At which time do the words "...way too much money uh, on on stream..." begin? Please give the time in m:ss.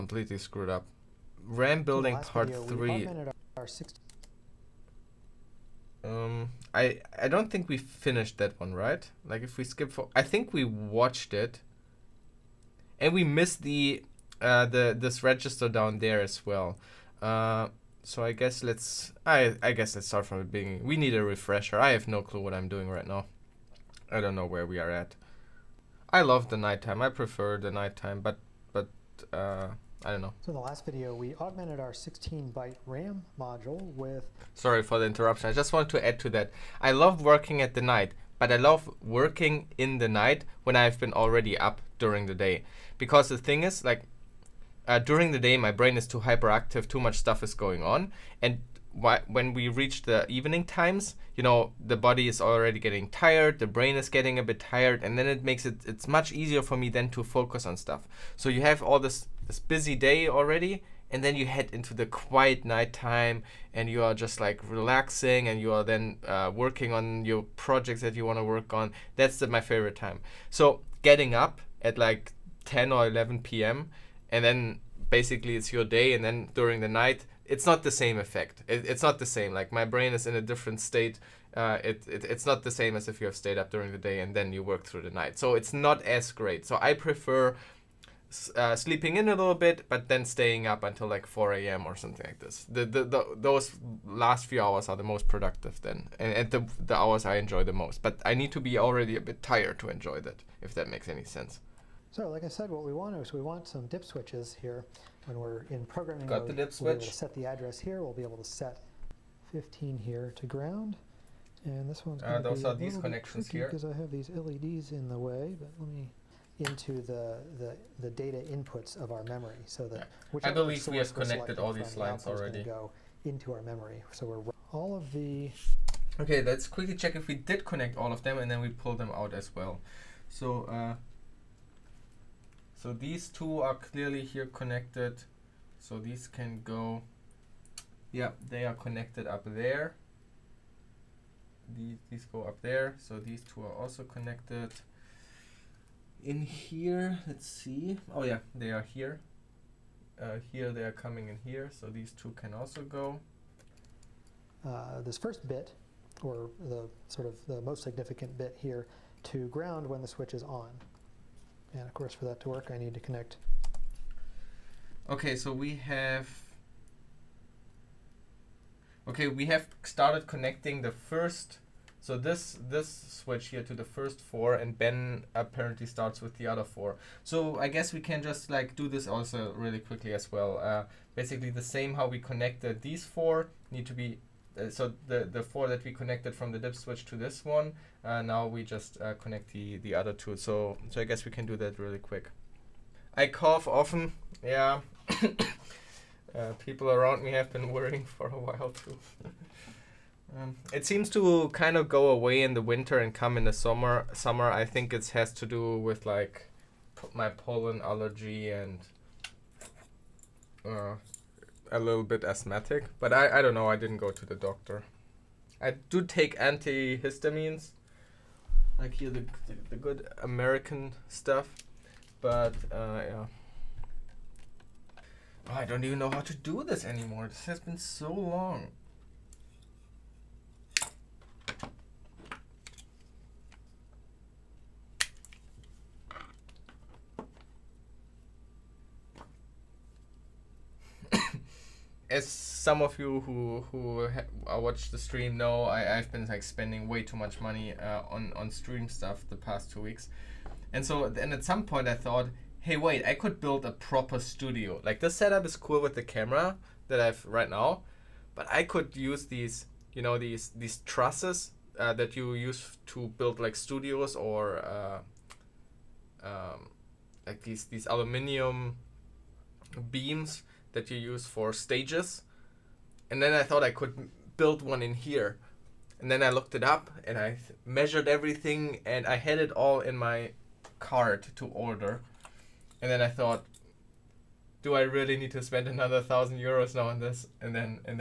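4:06.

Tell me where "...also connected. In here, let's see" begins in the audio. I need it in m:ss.
2:23.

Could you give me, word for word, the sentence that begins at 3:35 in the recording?
I do take antihistamines, like here the, the, the good American stuff, but uh, yeah.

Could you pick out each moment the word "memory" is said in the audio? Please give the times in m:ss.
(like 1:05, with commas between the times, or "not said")
1:59, 2:03.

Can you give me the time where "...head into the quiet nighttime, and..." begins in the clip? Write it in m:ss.
1:01.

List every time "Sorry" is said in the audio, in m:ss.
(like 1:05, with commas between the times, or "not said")
0:34.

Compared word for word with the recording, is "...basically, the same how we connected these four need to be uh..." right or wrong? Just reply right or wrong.
right.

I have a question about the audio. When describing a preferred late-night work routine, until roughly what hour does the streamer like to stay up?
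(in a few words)
4 a.m.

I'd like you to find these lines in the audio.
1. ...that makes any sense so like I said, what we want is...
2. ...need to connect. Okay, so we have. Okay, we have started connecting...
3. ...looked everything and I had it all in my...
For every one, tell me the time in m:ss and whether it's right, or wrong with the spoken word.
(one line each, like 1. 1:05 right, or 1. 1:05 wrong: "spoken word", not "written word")
1. 1:40 right
2. 2:42 right
3. 4:37 wrong: "measured", not "looked".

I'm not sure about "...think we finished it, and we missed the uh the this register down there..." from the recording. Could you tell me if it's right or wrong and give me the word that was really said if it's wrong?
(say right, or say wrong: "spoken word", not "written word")
wrong: "watched", not "finished".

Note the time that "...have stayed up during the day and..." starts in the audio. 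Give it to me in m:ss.
1:23.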